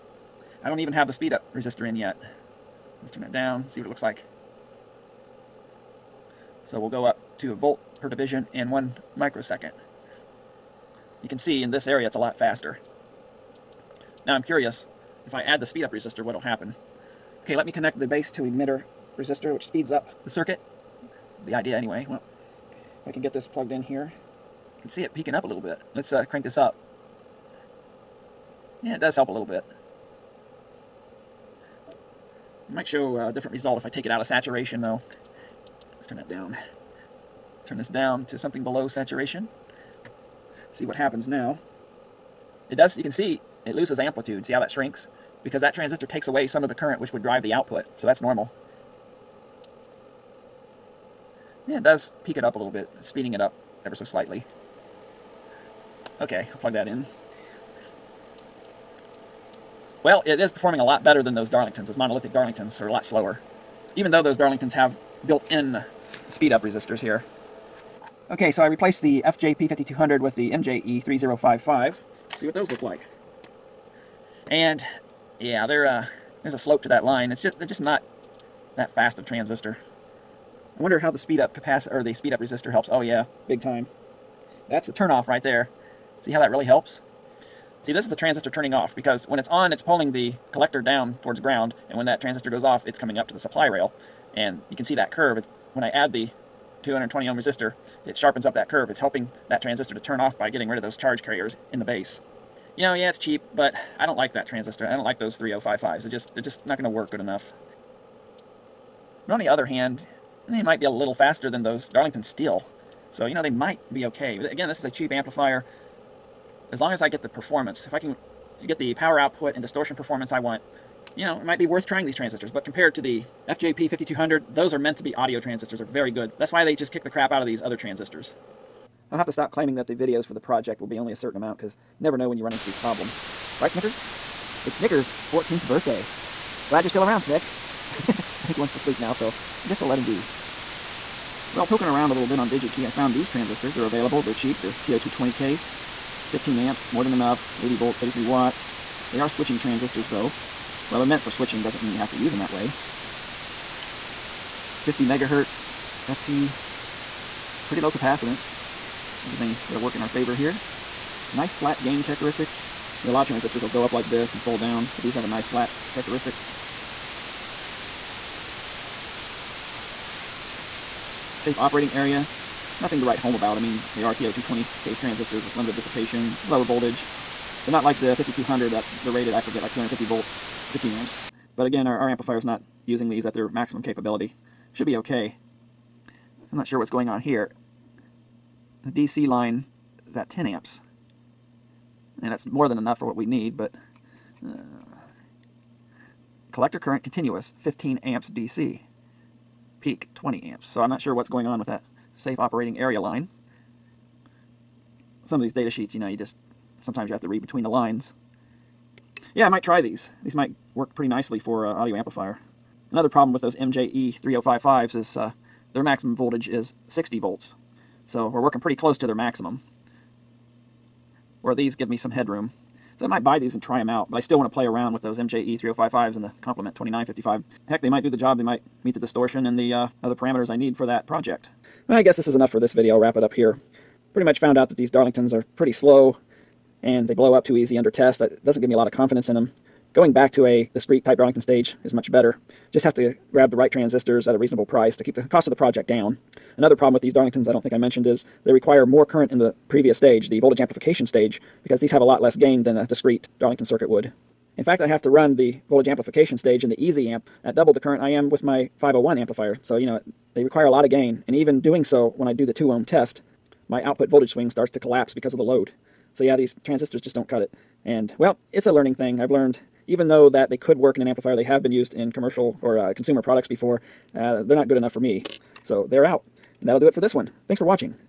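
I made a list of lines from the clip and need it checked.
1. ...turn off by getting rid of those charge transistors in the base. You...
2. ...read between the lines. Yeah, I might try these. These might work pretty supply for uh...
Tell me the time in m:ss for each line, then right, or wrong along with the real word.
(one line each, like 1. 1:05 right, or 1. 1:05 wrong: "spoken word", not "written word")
1. 1:39 wrong: "carriers", not "transistors"
2. 3:27 wrong: "nicely", not "supply".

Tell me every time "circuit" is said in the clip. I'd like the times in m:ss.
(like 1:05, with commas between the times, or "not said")
0:20, 4:13.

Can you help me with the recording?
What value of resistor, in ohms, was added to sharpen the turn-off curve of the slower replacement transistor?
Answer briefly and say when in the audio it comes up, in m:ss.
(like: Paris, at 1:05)
220 ohms, at 1:36.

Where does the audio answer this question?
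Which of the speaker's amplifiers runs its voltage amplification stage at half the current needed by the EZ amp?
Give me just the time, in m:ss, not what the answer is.
4:18.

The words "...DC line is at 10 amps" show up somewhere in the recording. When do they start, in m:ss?
3:08.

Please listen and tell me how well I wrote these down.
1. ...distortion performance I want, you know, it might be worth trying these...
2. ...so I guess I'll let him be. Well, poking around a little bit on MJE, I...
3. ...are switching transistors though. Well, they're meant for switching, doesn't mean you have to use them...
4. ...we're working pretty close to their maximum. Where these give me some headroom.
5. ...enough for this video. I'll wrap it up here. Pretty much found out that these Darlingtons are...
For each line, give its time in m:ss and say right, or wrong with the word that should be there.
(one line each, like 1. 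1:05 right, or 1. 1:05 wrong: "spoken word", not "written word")
1. 1:59 right
2. 2:19 wrong: "DigiKey", not "MJE"
3. 2:29 right
4. 3:38 right
5. 3:52 right.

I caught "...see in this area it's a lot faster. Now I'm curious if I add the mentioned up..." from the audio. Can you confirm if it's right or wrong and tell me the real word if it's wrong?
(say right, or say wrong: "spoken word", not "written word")
wrong: "speed", not "mentioned".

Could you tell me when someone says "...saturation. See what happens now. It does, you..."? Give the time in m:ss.
0:38.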